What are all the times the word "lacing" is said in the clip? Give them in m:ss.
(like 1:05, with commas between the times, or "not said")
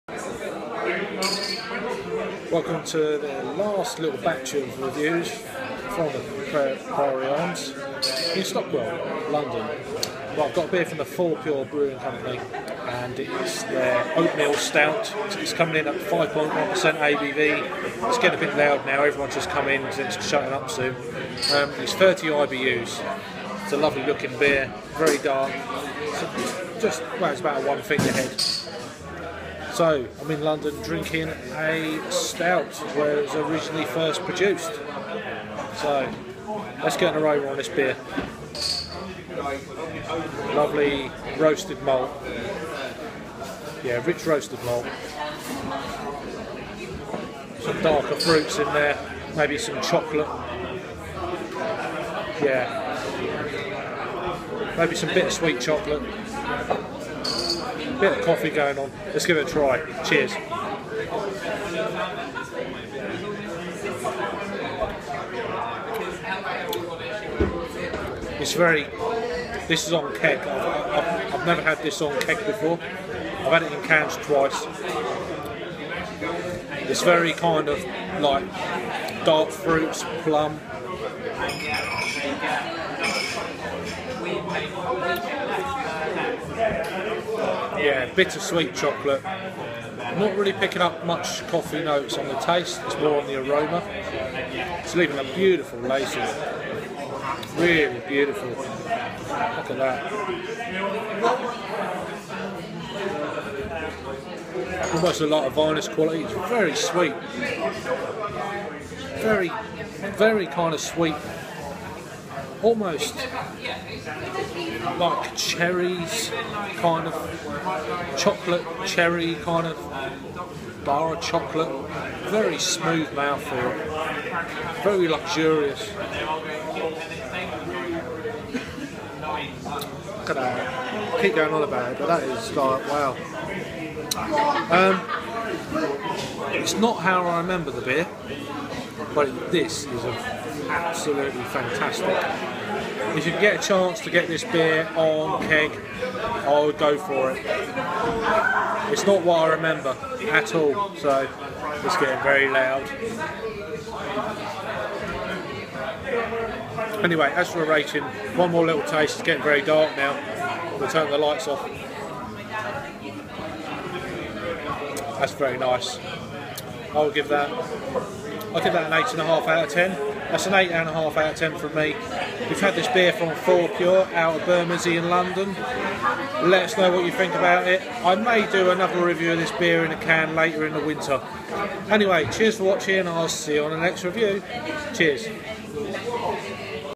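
1:35.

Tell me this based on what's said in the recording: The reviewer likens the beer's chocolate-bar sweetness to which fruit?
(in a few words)
cherries.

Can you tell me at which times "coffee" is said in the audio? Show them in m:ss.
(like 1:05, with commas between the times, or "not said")
0:58, 1:31.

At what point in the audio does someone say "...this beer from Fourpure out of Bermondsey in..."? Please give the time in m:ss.
2:52.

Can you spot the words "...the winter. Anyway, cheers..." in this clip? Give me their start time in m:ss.
3:00.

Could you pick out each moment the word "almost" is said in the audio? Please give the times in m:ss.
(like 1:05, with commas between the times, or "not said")
1:44, 1:52.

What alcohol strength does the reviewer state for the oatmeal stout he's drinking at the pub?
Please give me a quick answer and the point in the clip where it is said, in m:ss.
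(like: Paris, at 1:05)
5.1%, at 0:15.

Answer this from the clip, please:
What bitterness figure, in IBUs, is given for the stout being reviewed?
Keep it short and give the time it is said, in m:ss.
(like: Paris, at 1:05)
30, at 0:21.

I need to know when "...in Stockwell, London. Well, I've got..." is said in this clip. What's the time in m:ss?
0:08.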